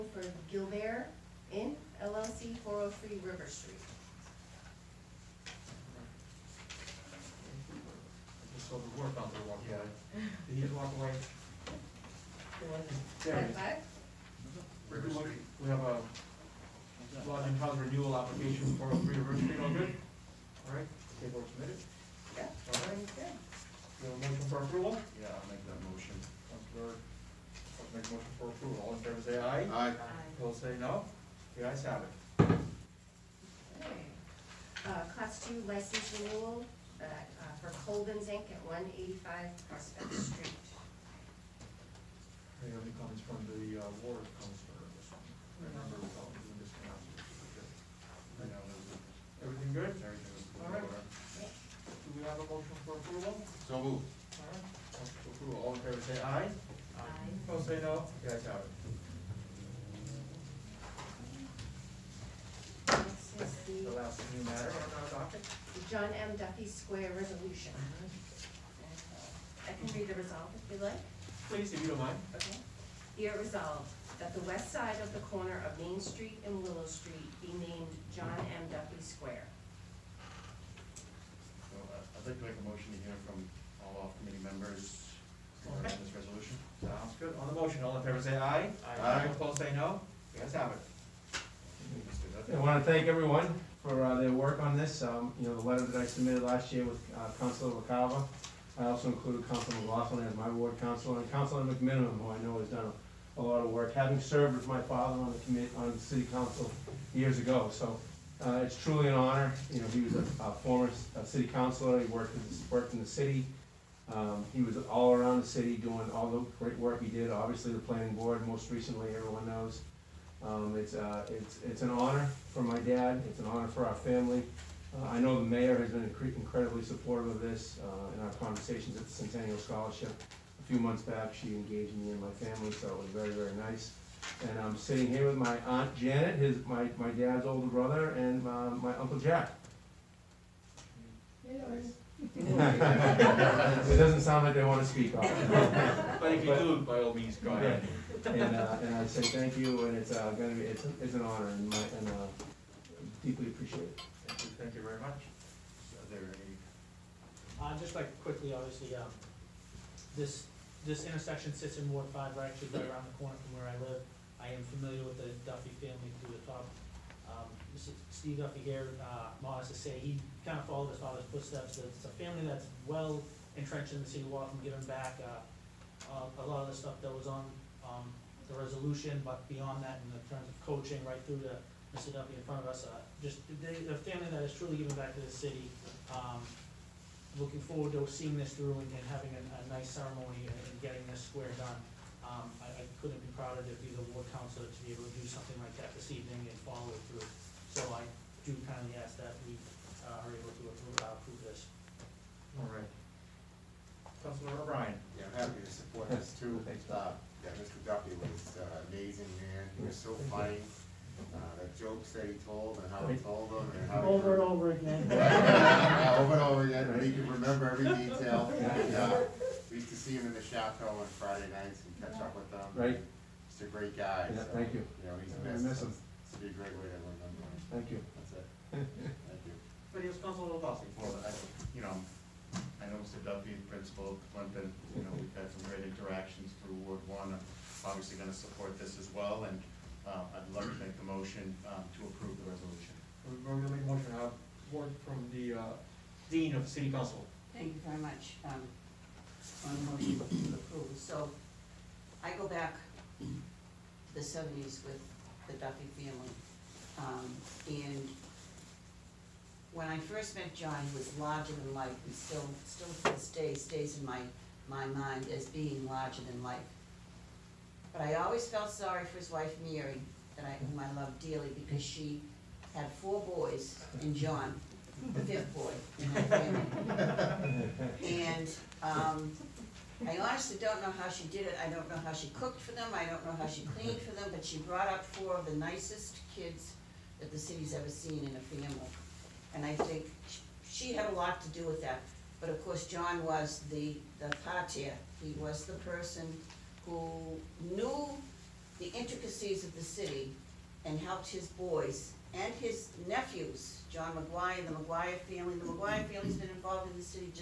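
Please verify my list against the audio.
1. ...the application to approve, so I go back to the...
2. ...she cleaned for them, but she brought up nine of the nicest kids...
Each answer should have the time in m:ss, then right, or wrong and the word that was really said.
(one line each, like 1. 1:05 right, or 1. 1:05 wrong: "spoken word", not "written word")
1. 4:09 wrong: "motion", not "application"
2. 4:43 wrong: "four", not "nine".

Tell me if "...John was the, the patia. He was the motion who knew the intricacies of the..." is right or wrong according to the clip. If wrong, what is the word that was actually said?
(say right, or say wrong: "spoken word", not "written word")
wrong: "person", not "motion".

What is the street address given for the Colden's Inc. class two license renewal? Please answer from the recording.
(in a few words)
185 Prospect Street.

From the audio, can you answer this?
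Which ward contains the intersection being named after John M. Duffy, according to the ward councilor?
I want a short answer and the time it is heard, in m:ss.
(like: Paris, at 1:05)
Ward 5, at 2:41.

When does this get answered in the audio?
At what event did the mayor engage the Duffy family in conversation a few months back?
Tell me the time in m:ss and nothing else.
2:09.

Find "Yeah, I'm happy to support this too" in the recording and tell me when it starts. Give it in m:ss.
3:25.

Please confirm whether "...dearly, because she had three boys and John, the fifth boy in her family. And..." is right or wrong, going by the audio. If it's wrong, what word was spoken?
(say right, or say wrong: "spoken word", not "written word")
wrong: "four", not "three".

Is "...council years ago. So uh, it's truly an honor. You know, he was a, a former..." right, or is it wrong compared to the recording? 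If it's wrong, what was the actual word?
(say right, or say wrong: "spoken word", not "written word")
right.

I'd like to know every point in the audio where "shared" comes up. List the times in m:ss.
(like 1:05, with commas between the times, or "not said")
not said.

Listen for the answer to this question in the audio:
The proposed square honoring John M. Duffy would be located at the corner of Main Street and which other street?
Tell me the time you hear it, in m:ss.
1:16.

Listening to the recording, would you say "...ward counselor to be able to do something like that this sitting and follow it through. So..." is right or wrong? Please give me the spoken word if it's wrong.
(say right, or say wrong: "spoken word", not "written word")
wrong: "evening", not "sitting".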